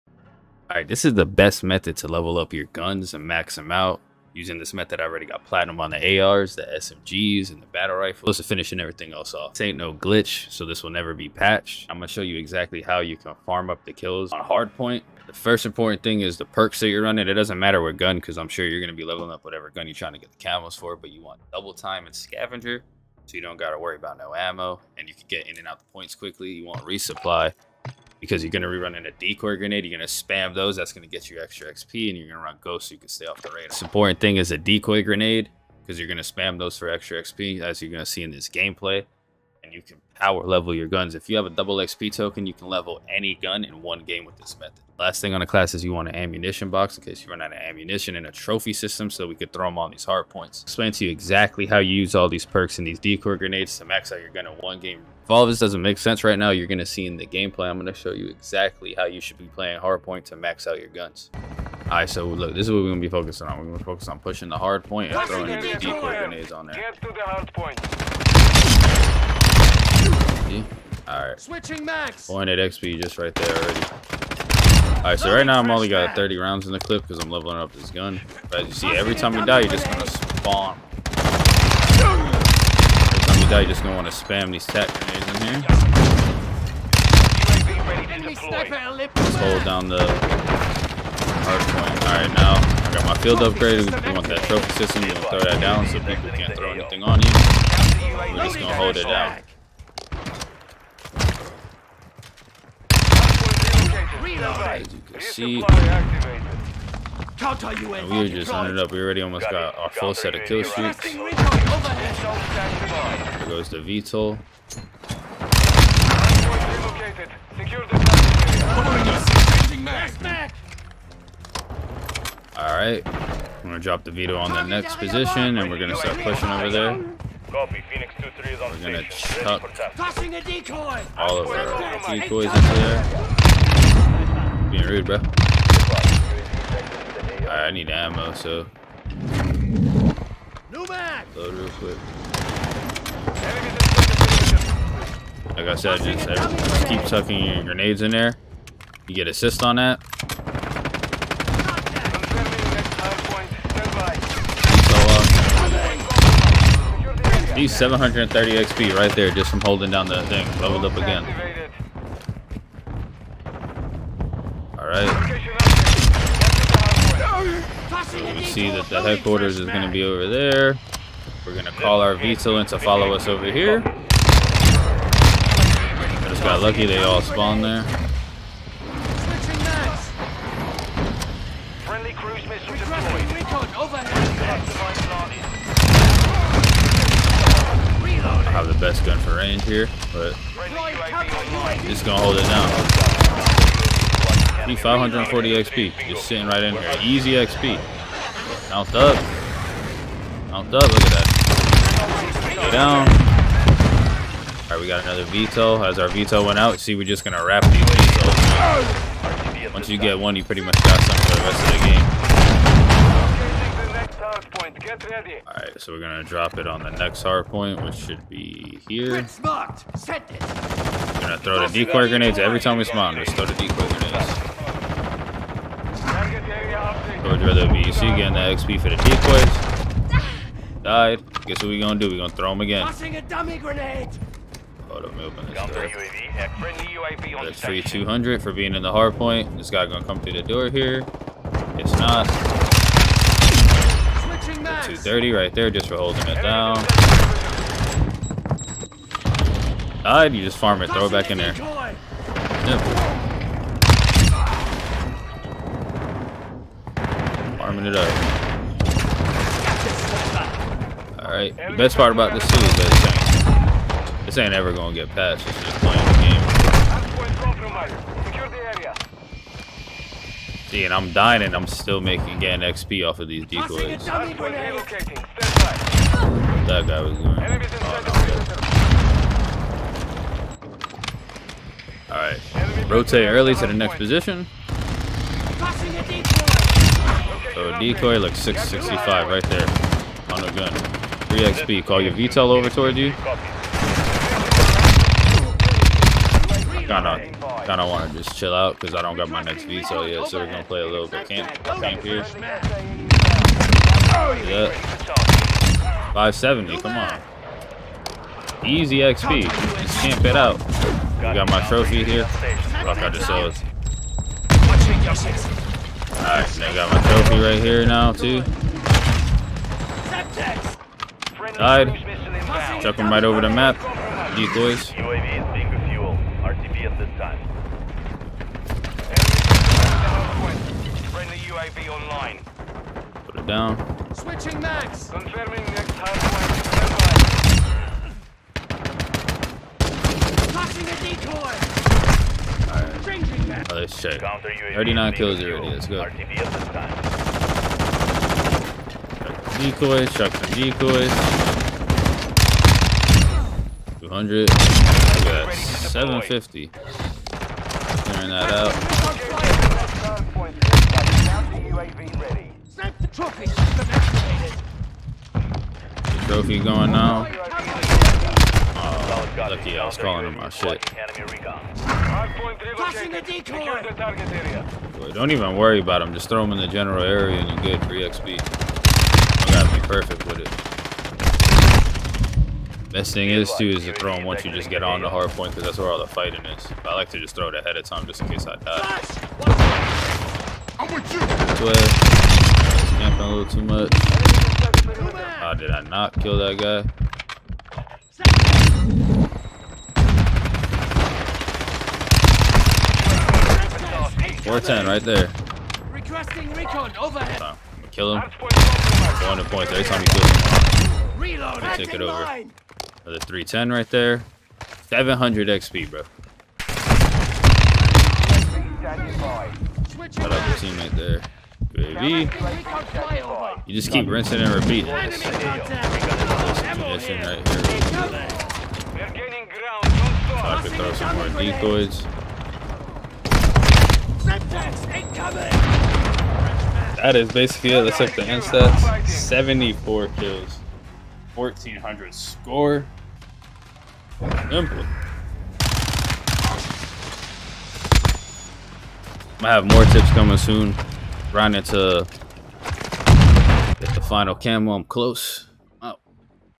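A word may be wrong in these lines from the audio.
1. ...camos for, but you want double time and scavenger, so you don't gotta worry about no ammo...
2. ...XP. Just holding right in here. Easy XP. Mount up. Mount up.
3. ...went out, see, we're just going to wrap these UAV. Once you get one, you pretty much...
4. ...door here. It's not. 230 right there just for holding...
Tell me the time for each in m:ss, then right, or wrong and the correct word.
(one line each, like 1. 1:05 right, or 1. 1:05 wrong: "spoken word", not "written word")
1. 0:20 right
2. 3:15 wrong: "sitting", not "holding"
3. 3:26 wrong: "VTOLs", not "UAV"
4. 4:00 right.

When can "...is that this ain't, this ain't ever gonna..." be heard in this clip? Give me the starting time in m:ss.
4:22.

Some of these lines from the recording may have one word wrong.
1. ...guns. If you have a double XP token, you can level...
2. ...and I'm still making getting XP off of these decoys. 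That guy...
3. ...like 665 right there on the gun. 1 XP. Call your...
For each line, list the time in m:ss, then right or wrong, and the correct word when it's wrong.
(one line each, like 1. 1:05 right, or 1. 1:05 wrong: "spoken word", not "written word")
1. 0:40 right
2. 4:31 right
3. 4:48 wrong: "3", not "1".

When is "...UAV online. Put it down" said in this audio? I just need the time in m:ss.
5:31.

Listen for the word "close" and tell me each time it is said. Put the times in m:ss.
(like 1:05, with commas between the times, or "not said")
0:08, 7:34.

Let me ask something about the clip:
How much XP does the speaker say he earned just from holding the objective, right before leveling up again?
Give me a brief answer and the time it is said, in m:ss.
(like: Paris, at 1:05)
730, at 2:37.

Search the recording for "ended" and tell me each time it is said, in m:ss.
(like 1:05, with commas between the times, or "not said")
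1:48.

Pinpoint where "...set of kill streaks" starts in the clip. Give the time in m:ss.
1:50.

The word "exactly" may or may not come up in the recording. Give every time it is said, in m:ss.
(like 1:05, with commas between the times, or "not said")
0:12, 0:51, 0:58.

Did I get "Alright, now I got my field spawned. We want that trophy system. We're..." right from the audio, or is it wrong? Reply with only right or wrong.
wrong.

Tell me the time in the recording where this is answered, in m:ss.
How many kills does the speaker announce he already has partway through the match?
5:43.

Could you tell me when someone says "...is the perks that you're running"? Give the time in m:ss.
0:16.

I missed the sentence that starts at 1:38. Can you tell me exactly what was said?
We're just gonna hold it down.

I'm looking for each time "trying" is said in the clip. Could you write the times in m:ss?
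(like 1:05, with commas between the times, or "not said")
0:19.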